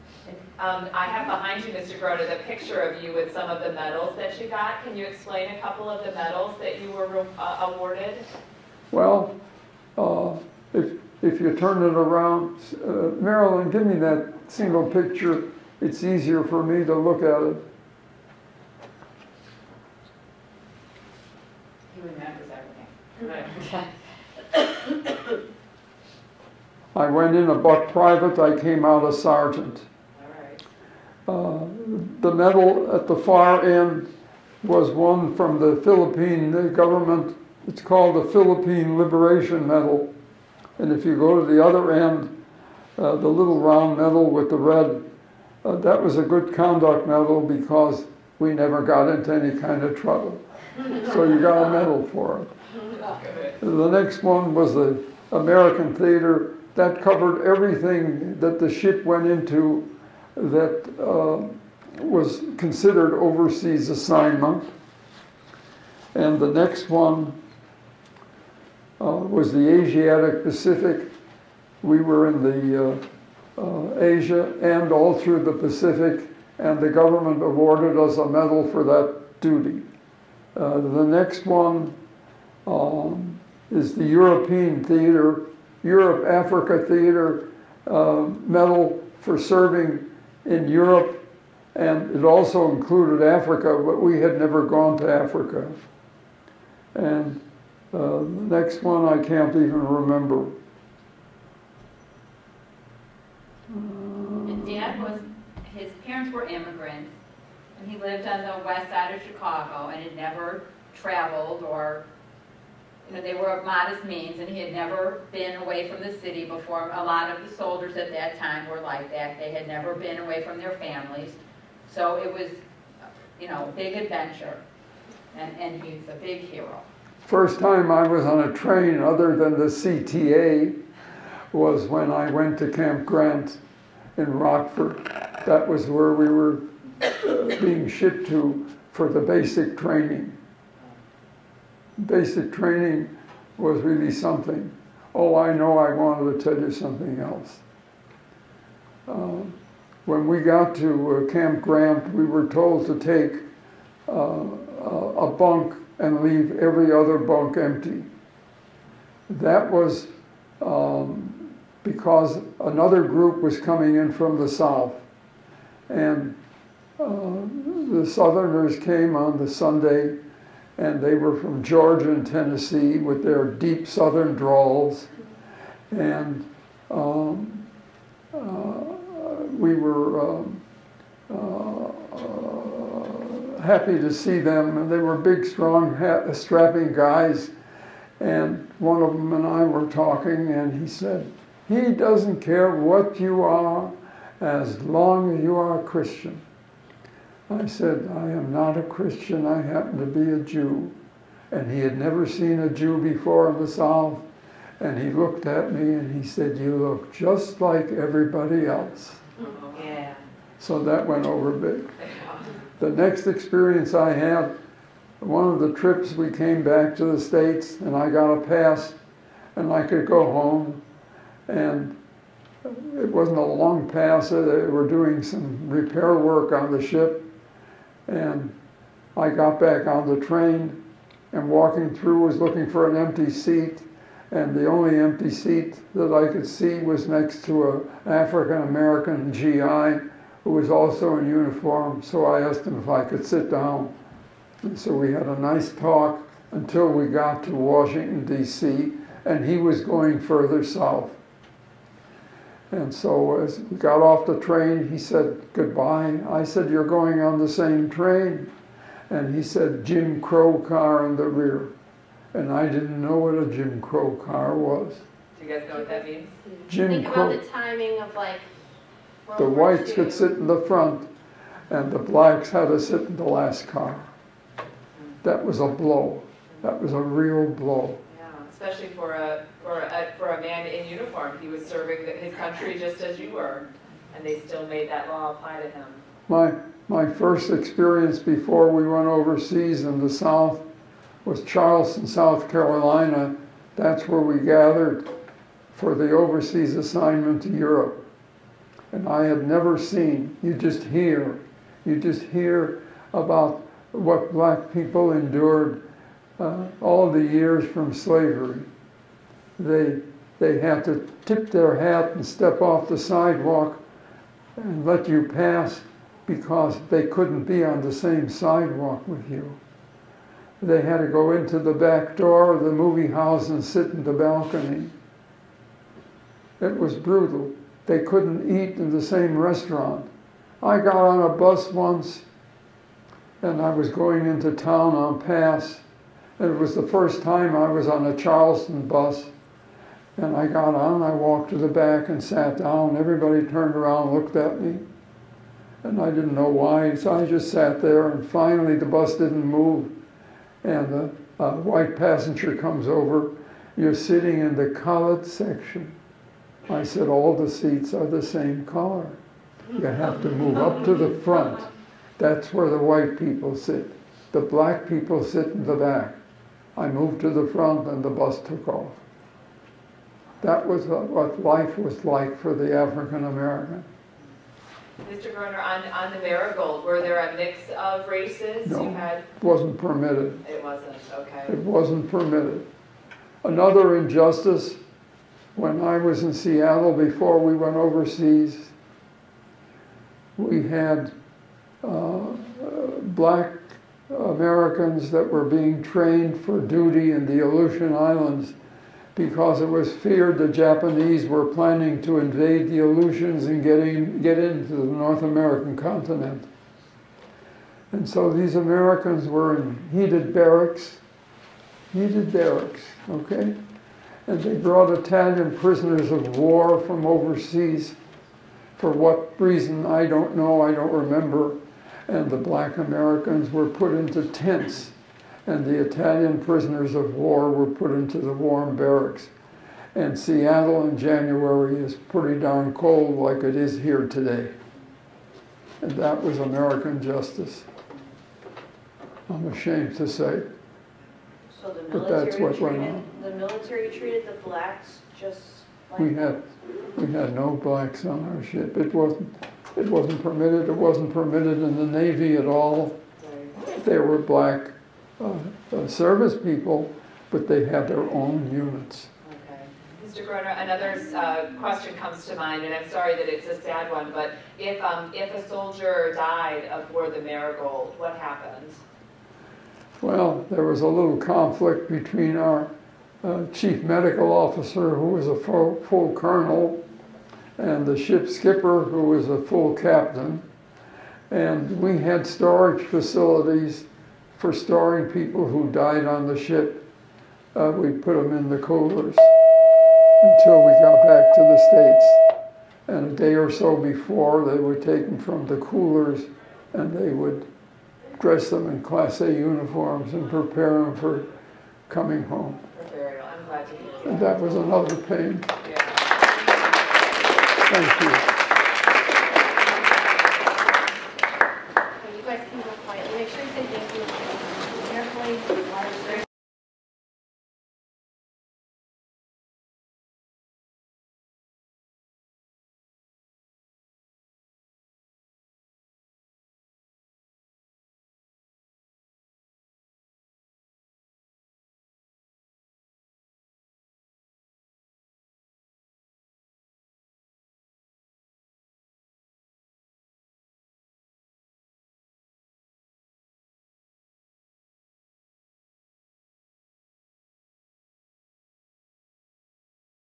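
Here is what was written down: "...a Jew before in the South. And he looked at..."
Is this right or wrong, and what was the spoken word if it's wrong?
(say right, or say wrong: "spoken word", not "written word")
right.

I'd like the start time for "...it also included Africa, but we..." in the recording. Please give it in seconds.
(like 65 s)
92 s.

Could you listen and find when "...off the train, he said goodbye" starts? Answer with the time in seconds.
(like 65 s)
254 s.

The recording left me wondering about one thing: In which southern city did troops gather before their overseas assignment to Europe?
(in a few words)
Charleston, South Carolina.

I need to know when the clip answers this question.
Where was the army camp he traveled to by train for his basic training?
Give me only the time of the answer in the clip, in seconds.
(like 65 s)
134 s.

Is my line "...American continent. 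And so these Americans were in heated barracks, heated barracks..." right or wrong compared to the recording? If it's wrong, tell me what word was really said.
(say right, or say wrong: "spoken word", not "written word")
right.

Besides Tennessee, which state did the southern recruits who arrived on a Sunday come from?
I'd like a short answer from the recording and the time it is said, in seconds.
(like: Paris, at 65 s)
Georgia, at 171 s.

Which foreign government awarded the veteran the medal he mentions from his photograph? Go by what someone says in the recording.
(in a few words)
Philippine government.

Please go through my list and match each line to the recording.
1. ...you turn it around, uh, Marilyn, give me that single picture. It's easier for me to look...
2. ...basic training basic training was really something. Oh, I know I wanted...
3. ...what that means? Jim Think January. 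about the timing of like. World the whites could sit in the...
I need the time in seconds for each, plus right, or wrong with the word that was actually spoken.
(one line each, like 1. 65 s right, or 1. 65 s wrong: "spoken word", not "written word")
1. 11 s right
2. 139 s right
3. 265 s wrong: "Crow", not "January".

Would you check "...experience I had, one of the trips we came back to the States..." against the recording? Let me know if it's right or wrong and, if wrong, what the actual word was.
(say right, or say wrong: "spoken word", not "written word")
right.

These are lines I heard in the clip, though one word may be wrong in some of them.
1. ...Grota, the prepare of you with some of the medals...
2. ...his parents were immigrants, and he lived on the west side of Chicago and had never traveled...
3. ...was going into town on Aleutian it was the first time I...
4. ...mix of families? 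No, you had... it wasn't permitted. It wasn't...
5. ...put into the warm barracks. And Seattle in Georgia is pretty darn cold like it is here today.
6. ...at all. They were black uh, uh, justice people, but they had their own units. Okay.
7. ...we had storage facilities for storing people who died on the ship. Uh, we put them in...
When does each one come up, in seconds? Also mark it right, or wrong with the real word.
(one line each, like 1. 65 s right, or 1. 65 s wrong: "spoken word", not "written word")
1. 1 s wrong: "picture", not "prepare"
2. 105 s right
3. 333 s wrong: "Pass", not "Aleutian"
4. 377 s wrong: "races", not "families"
5. 427 s wrong: "January", not "Georgia"
6. 452 s wrong: "service", not "justice"
7. 481 s right.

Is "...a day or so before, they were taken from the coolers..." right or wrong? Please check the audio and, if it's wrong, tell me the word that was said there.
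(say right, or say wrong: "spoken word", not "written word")
right.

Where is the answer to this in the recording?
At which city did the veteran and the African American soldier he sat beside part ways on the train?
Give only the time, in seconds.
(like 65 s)
247 s.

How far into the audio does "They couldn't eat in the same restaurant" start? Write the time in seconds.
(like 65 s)
327 s.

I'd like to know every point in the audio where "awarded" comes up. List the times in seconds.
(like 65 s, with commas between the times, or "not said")
7 s, 77 s.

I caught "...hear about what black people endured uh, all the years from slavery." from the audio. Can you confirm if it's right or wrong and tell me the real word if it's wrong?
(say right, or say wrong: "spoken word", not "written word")
right.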